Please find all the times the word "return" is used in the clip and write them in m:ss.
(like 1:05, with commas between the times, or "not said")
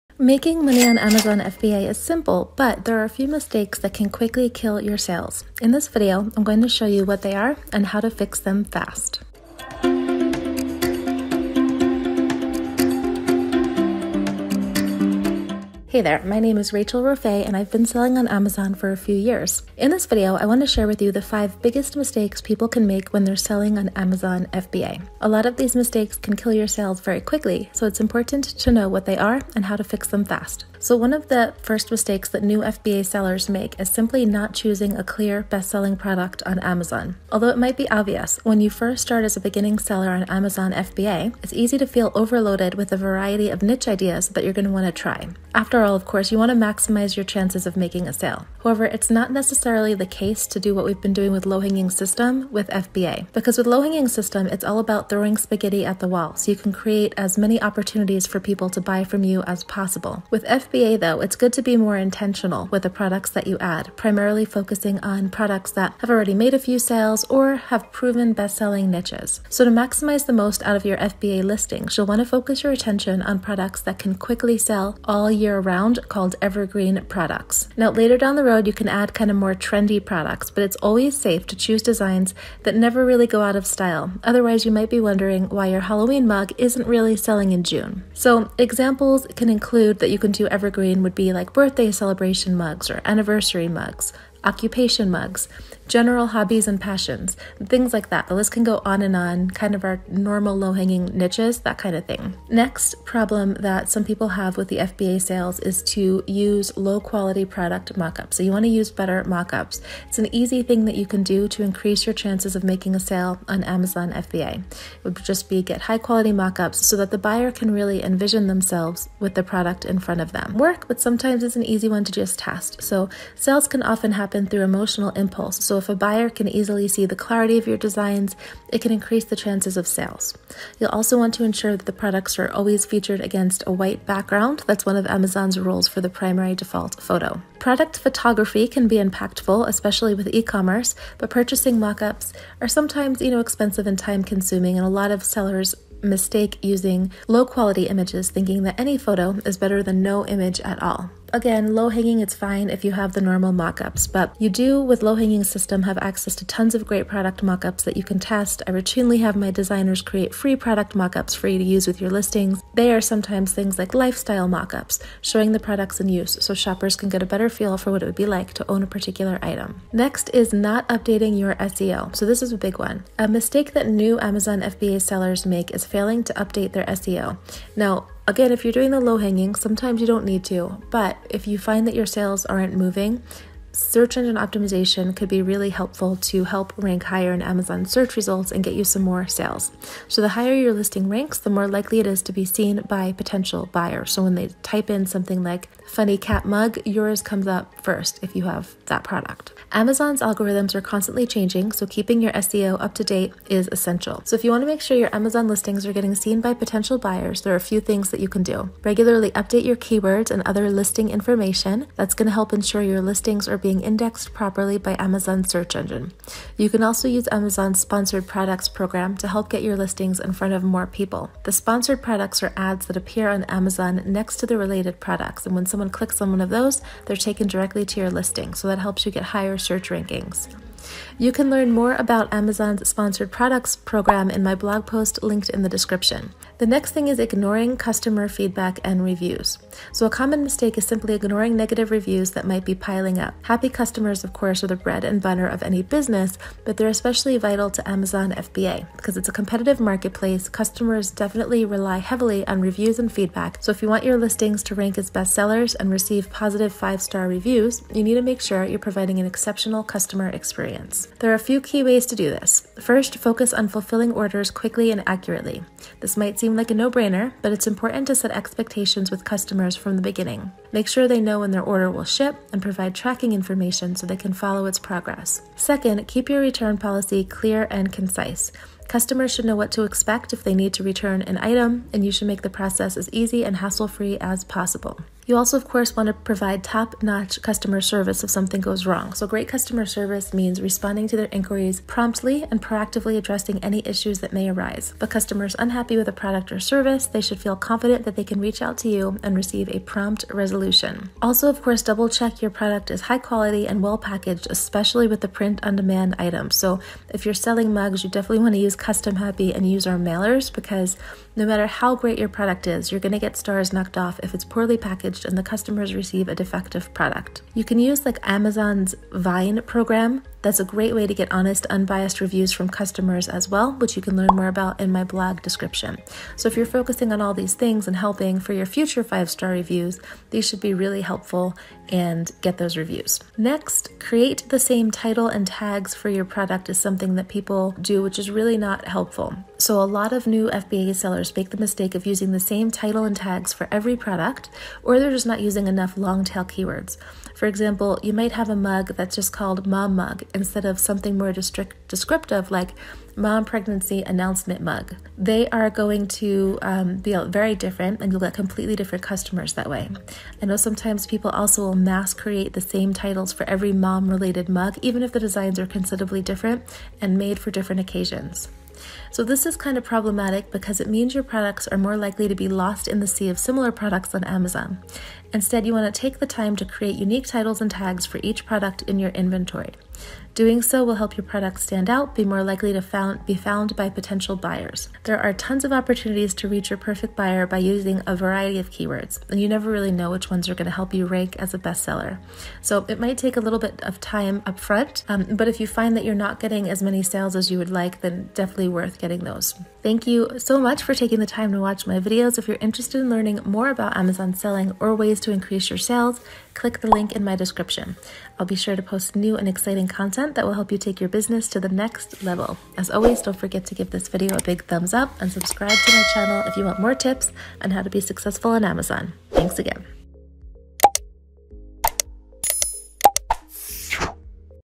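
4:36, 4:40.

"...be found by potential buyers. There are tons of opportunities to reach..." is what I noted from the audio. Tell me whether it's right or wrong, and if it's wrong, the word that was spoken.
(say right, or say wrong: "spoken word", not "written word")
right.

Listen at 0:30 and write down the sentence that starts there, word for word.
So, one of the first mistakes that new FBA sellers make is simply not choosing a clear best selling product on Amazon.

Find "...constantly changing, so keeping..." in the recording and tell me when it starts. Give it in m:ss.
3:20.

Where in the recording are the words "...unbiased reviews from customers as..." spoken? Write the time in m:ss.
5:21.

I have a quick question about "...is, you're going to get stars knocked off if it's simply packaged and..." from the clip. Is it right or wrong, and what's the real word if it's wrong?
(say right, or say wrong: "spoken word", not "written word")
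wrong: "poorly", not "simply".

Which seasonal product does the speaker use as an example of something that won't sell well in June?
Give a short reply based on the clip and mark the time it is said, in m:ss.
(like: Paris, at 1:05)
Halloween mug, at 1:25.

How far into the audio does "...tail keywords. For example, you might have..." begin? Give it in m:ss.
5:46.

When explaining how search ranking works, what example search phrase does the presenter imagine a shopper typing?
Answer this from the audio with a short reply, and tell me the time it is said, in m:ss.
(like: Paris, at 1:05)
funny cat mug, at 3:15.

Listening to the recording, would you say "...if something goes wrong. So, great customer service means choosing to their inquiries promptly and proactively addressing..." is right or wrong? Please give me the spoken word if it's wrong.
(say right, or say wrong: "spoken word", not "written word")
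wrong: "responding", not "choosing".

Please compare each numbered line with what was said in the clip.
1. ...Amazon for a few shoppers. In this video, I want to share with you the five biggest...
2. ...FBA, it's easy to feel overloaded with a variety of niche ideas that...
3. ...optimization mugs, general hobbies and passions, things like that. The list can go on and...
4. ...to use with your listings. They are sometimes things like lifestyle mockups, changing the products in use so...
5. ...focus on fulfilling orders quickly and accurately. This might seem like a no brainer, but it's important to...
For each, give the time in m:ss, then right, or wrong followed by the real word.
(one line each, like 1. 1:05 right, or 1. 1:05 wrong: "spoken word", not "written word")
1. 0:18 wrong: "years", not "shoppers"
2. 0:40 right
3. 1:34 wrong: "occupation", not "optimization"
4. 2:41 wrong: "showing", not "changing"
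5. 4:23 right.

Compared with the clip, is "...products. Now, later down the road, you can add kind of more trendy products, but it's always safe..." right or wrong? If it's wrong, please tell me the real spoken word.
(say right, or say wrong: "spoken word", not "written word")
right.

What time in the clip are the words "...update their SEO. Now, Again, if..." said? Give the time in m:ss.
2:56.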